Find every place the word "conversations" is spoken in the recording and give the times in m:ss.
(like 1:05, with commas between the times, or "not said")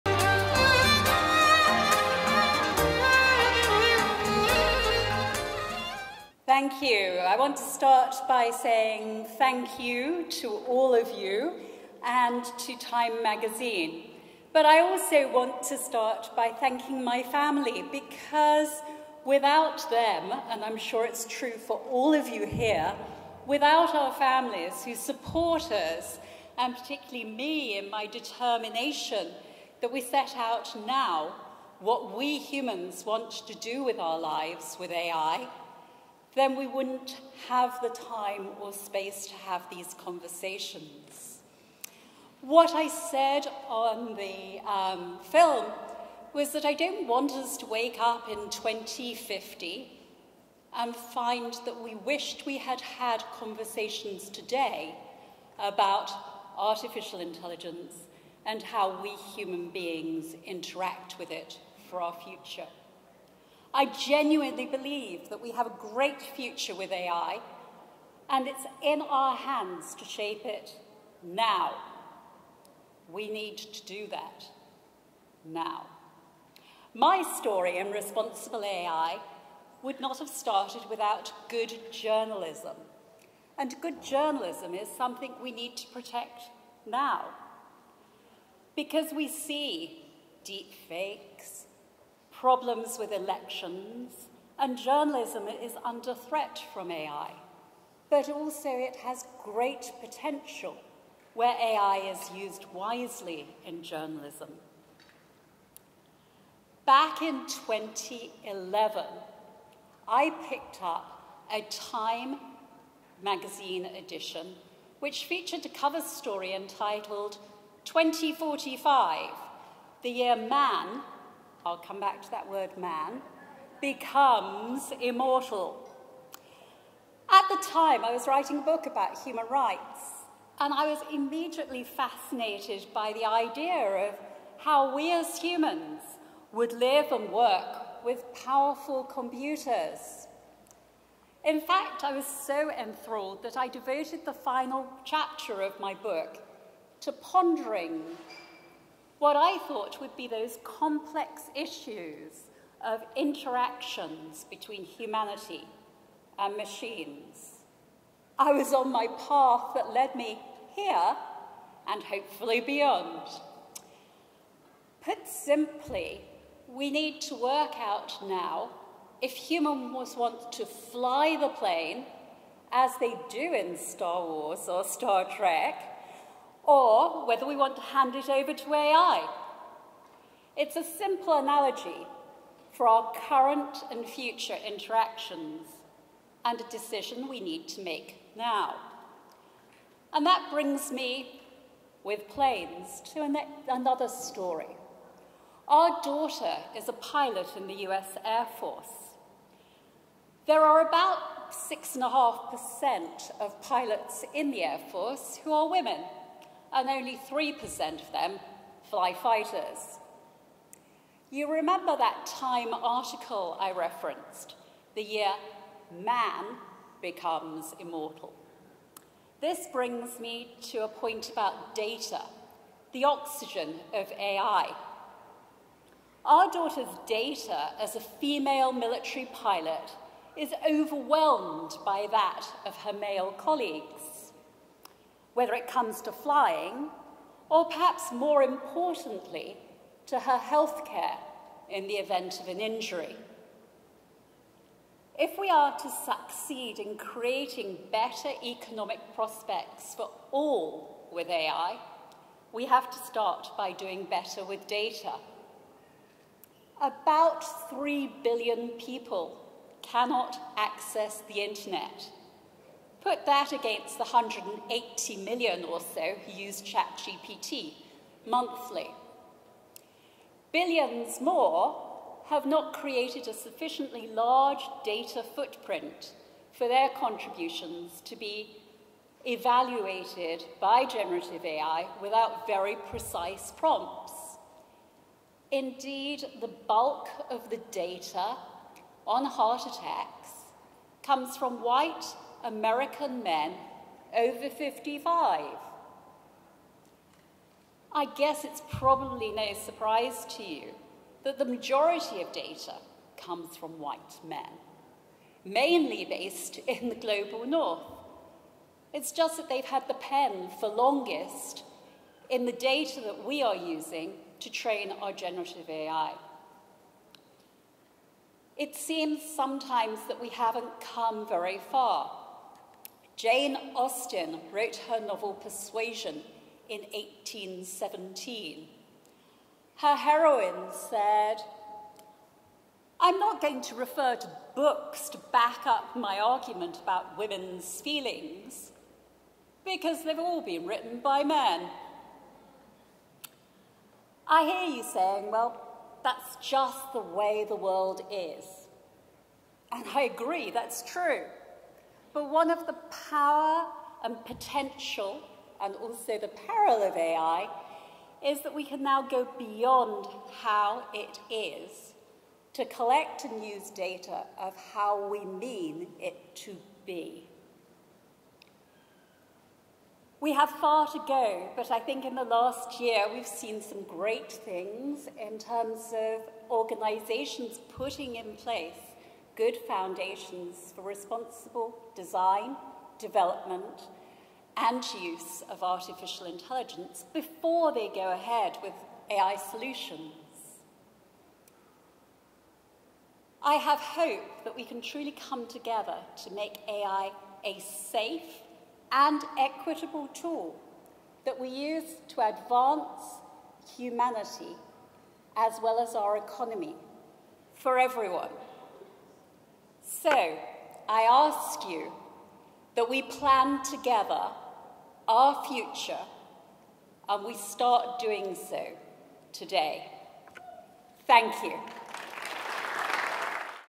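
0:39, 0:53.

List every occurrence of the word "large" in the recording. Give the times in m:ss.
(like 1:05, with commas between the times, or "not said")
4:34.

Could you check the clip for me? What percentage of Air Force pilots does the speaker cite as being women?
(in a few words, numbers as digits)
6.5%.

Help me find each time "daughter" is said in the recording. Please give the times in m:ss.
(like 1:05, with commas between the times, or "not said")
3:16, 3:46.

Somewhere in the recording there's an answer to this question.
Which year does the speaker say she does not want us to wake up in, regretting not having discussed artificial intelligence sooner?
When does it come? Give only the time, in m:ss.
0:48.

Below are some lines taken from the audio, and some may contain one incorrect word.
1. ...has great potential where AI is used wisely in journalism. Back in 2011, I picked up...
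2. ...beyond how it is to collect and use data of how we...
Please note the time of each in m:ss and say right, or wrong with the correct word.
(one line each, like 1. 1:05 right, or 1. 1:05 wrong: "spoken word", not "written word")
1. 1:38 right
2. 5:59 right.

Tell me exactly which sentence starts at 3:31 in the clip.
You remember that Time article I referenced, the year man becomes immortal.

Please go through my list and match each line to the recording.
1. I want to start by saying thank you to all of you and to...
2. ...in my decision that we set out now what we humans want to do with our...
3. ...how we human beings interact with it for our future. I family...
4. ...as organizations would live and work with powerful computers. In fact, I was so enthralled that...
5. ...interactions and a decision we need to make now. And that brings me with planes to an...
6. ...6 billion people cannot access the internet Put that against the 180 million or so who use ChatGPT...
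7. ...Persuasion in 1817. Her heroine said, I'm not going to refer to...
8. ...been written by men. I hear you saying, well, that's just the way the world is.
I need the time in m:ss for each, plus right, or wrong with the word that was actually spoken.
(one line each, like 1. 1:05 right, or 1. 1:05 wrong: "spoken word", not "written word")
1. 0:07 right
2. 0:27 wrong: "determination", not "decision"
3. 0:58 wrong: "genuinely", not "family"
4. 2:15 wrong: "humans", not "organizations"
5. 3:04 right
6. 4:17 wrong: "3", not "6"
7. 5:25 right
8. 5:40 right.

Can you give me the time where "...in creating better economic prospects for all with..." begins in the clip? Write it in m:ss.
4:06.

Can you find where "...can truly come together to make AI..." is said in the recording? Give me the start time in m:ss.
6:34.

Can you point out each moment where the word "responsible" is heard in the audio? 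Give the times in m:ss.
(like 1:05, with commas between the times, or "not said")
1:17, 6:20.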